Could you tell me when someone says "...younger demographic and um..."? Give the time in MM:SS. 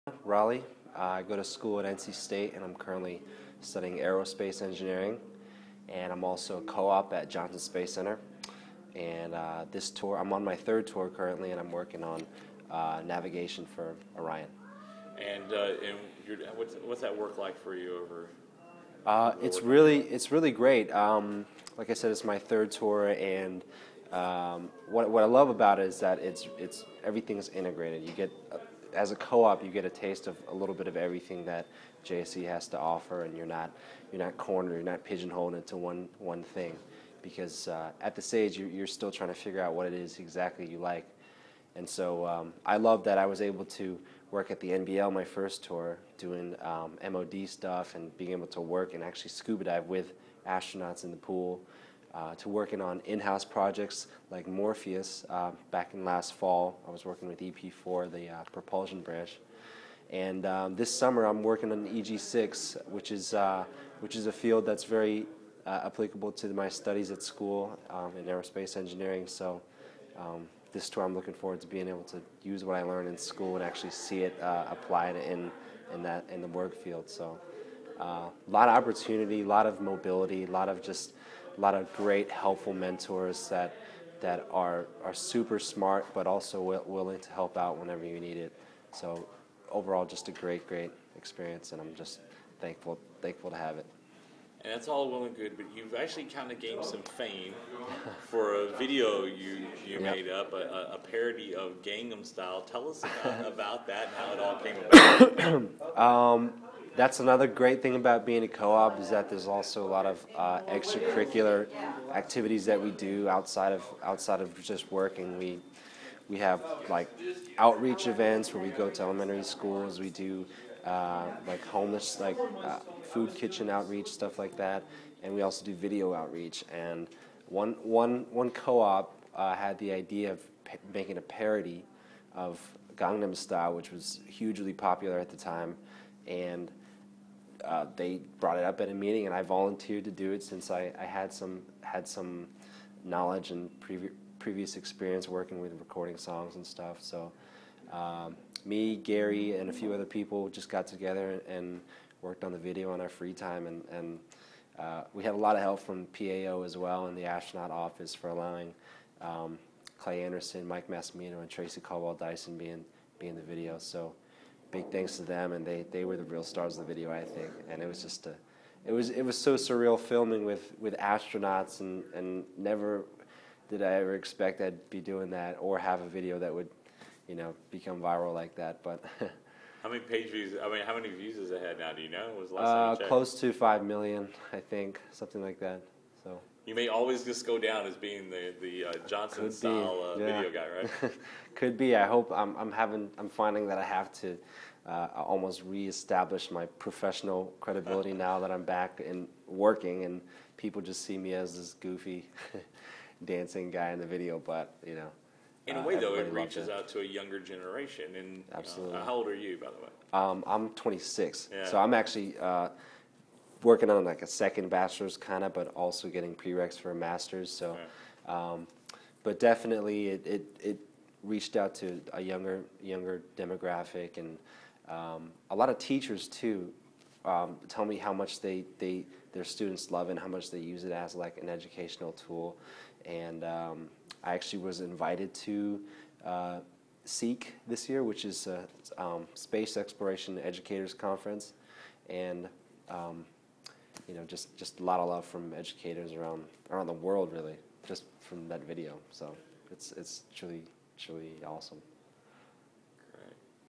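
03:42.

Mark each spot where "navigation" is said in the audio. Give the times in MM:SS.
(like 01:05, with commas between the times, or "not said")
00:13.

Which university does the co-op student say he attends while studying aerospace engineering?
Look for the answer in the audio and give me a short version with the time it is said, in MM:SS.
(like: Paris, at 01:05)
NC State, at 00:01.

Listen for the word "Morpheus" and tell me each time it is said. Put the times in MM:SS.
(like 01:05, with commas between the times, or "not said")
00:54.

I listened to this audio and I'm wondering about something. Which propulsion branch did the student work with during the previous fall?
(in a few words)
EP4.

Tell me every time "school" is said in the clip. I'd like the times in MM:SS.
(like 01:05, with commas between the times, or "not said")
00:01, 01:07, 01:13, 01:59.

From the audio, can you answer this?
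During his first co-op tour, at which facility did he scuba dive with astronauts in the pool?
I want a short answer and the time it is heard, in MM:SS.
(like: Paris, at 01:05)
the NBL, at 00:44.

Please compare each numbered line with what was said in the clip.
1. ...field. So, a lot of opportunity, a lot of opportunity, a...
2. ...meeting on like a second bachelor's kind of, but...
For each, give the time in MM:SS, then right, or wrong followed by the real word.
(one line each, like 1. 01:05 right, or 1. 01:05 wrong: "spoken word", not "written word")
1. 01:16 wrong: "mobility", not "opportunity"
2. 03:33 wrong: "working", not "meeting".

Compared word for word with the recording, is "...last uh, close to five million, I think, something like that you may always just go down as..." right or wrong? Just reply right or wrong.
right.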